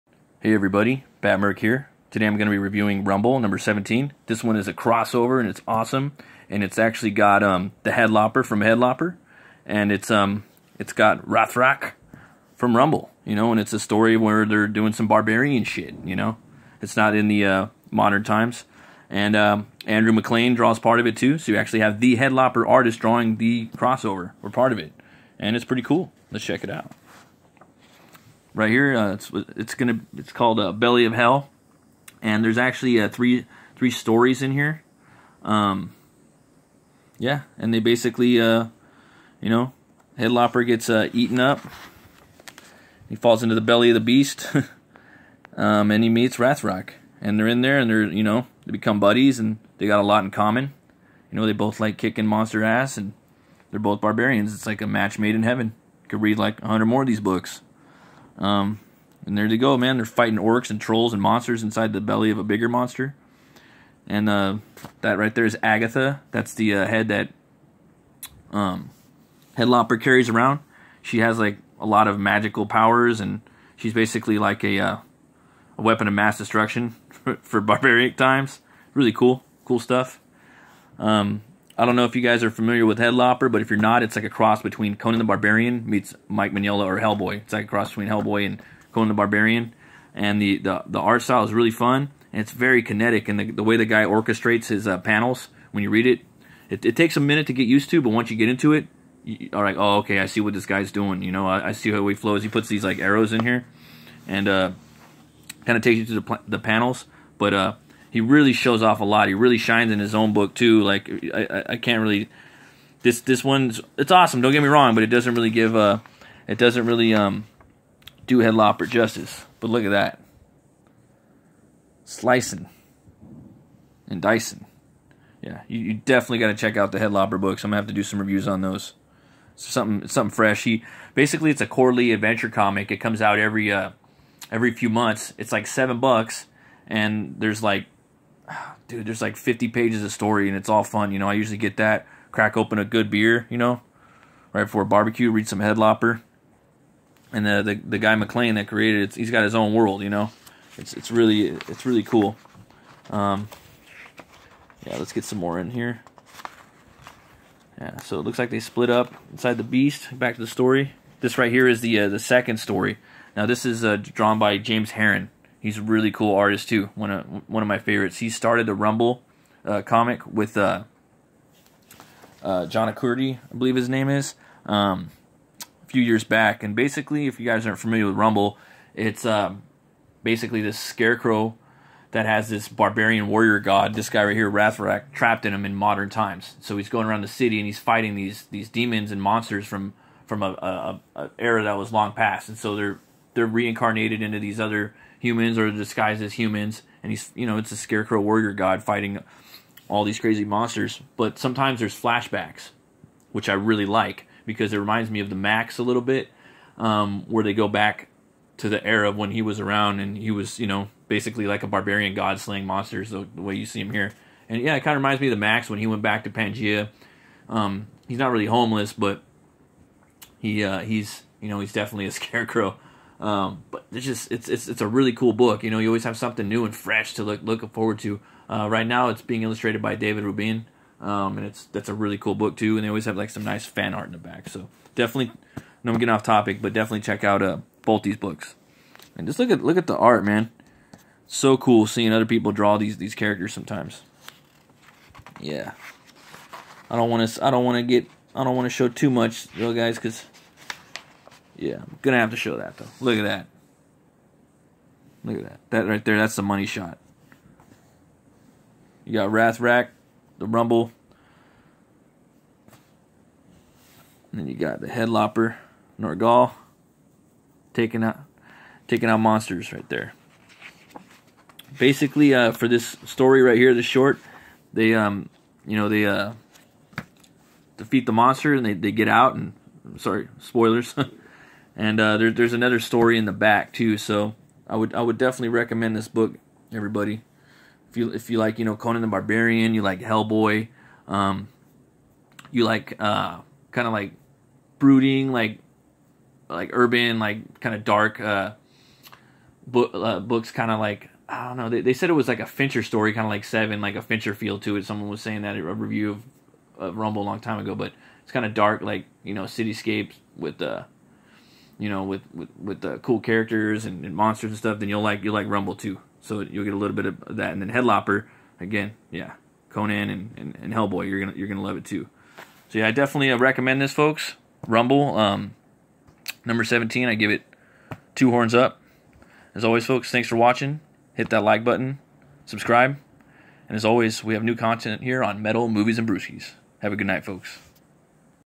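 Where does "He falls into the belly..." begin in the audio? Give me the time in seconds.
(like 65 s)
43 s.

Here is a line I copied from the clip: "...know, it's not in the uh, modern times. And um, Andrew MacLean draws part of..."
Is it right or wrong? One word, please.
right.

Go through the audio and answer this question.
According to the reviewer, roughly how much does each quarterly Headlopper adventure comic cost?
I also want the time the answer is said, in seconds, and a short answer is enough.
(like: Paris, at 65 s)
$7, at 135 s.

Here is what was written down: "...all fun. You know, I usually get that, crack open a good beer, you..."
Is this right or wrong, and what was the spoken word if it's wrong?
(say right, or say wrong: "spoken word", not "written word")
right.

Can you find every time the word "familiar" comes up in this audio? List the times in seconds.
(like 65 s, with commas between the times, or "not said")
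82 s, 177 s.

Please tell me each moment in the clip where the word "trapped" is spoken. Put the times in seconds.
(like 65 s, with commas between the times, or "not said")
185 s.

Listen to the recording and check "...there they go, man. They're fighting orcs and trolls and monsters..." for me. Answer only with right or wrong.
right.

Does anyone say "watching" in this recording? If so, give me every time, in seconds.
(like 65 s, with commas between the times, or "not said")
330 s.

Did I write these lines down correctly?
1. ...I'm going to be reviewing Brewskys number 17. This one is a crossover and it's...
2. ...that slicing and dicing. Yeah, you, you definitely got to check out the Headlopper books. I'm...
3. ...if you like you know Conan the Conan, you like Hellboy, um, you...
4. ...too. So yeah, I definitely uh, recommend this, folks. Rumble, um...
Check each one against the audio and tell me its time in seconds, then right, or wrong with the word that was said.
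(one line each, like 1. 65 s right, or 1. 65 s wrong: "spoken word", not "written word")
1. 2 s wrong: "Rumble", not "Brewskys"
2. 119 s right
3. 288 s wrong: "Barbarian", not "Conan"
4. 321 s right.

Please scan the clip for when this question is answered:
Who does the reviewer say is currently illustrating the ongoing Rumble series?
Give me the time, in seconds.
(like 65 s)
229 s.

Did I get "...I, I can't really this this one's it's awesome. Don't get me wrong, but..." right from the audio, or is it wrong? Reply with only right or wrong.
right.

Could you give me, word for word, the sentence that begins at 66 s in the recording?
That's the uh, head that um, Headlopper carries around.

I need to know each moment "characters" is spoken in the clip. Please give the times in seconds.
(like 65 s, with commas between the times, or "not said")
243 s, 313 s.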